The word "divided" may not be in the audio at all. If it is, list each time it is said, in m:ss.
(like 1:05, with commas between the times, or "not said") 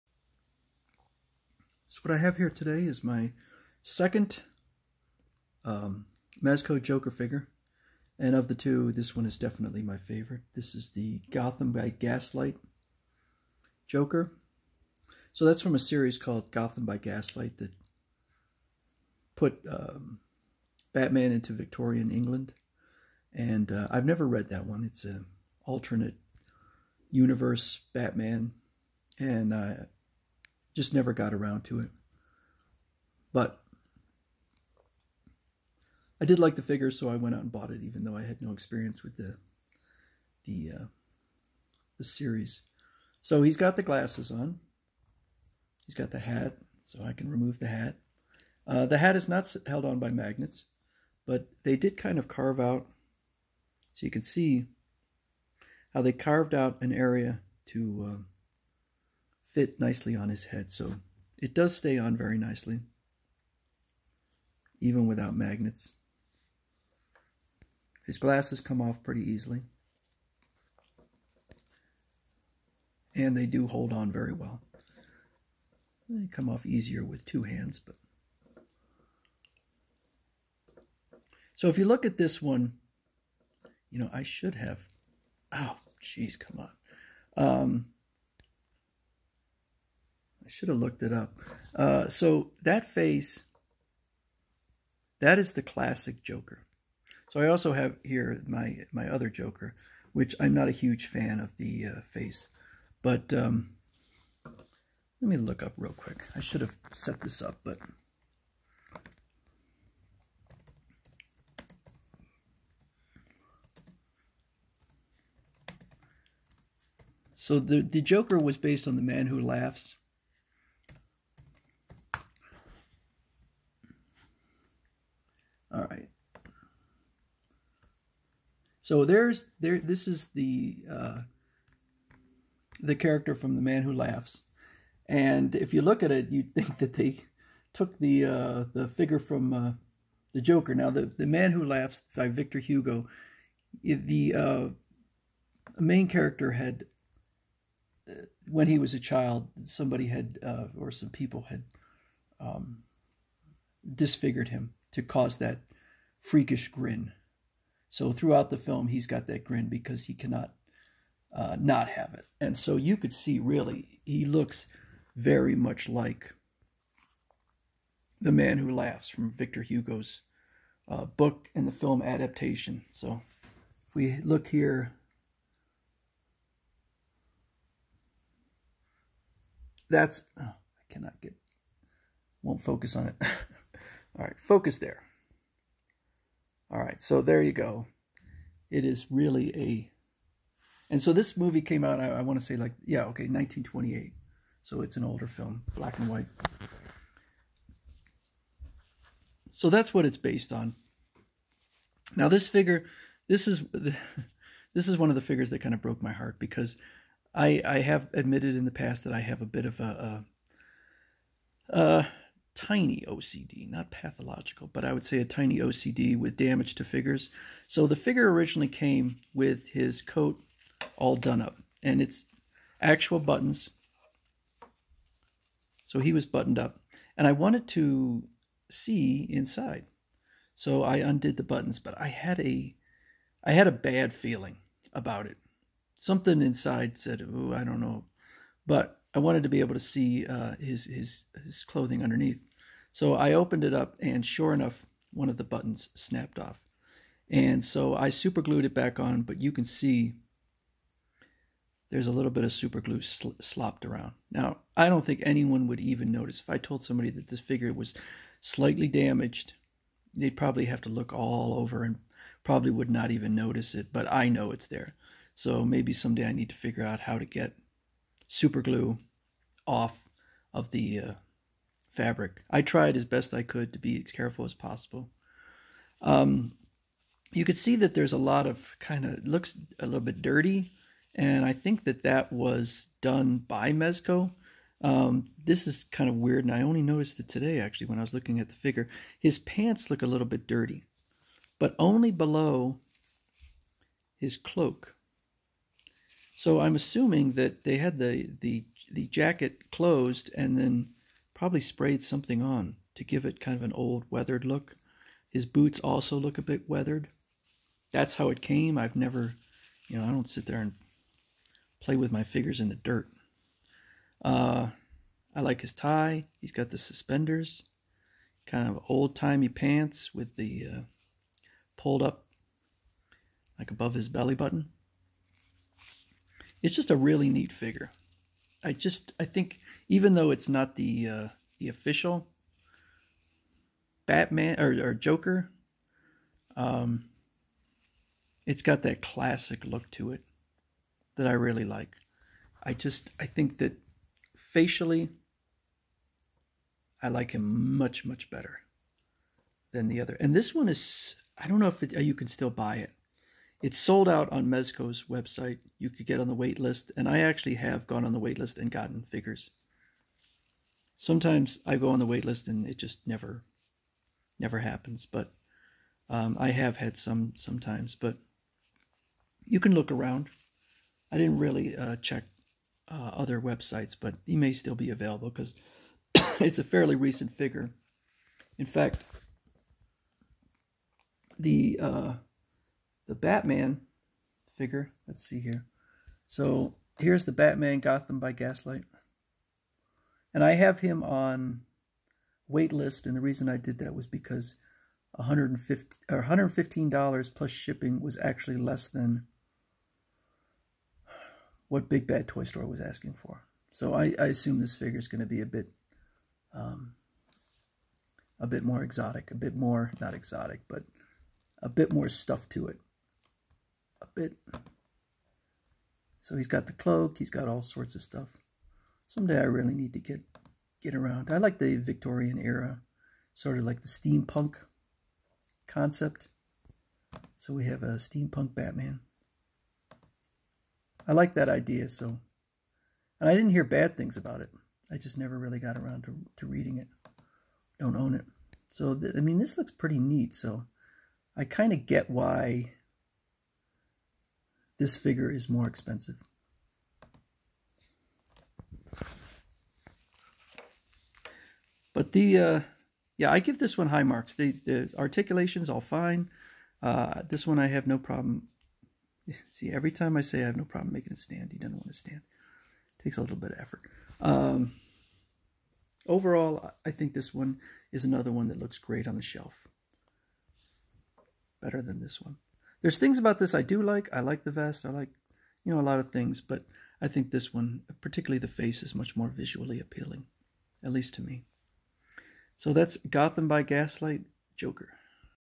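not said.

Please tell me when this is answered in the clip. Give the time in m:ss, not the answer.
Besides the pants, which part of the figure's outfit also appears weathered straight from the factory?
5:05.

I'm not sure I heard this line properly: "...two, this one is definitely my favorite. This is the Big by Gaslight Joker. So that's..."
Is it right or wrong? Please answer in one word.
wrong.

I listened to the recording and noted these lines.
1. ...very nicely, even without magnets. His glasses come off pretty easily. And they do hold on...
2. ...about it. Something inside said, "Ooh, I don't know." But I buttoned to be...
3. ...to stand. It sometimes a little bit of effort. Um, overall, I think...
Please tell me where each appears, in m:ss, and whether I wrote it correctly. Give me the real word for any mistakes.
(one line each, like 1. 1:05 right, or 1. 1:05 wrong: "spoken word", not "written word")
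1. 1:02 right
2. 3:54 wrong: "wanted", not "buttoned"
3. 7:41 wrong: "takes", not "sometimes".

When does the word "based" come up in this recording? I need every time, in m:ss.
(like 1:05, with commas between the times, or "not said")
1:58, 3:20.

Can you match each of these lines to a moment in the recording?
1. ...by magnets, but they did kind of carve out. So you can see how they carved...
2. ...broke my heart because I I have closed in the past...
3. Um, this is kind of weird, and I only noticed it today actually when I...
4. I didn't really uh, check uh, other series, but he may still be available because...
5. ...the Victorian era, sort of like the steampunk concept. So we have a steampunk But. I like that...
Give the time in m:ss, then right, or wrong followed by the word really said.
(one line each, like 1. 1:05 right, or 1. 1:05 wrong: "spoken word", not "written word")
1. 0:49 right
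2. 3:25 wrong: "admitted", not "closed"
3. 4:44 right
4. 6:11 wrong: "websites", not "series"
5. 7:01 wrong: "Batman", not "But".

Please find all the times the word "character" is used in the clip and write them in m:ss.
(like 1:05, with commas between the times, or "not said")
2:12, 2:26.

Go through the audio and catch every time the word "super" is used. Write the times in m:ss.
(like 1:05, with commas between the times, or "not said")
4:08, 4:12, 4:28.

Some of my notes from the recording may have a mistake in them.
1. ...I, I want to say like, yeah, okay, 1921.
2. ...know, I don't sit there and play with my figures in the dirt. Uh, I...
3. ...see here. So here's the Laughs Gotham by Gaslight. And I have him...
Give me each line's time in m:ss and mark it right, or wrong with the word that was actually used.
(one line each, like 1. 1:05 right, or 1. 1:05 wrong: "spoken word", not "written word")
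1. 3:11 wrong: "1928", not "1921"
2. 5:09 right
3. 6:25 wrong: "Batman", not "Laughs".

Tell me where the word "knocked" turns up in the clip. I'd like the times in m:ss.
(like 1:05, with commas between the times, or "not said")
not said.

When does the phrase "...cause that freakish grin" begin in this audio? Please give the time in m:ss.
2:35.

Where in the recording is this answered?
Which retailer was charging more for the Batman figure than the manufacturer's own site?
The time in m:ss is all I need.
6:41.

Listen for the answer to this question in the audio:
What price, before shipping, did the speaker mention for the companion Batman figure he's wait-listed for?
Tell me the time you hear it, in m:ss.
6:36.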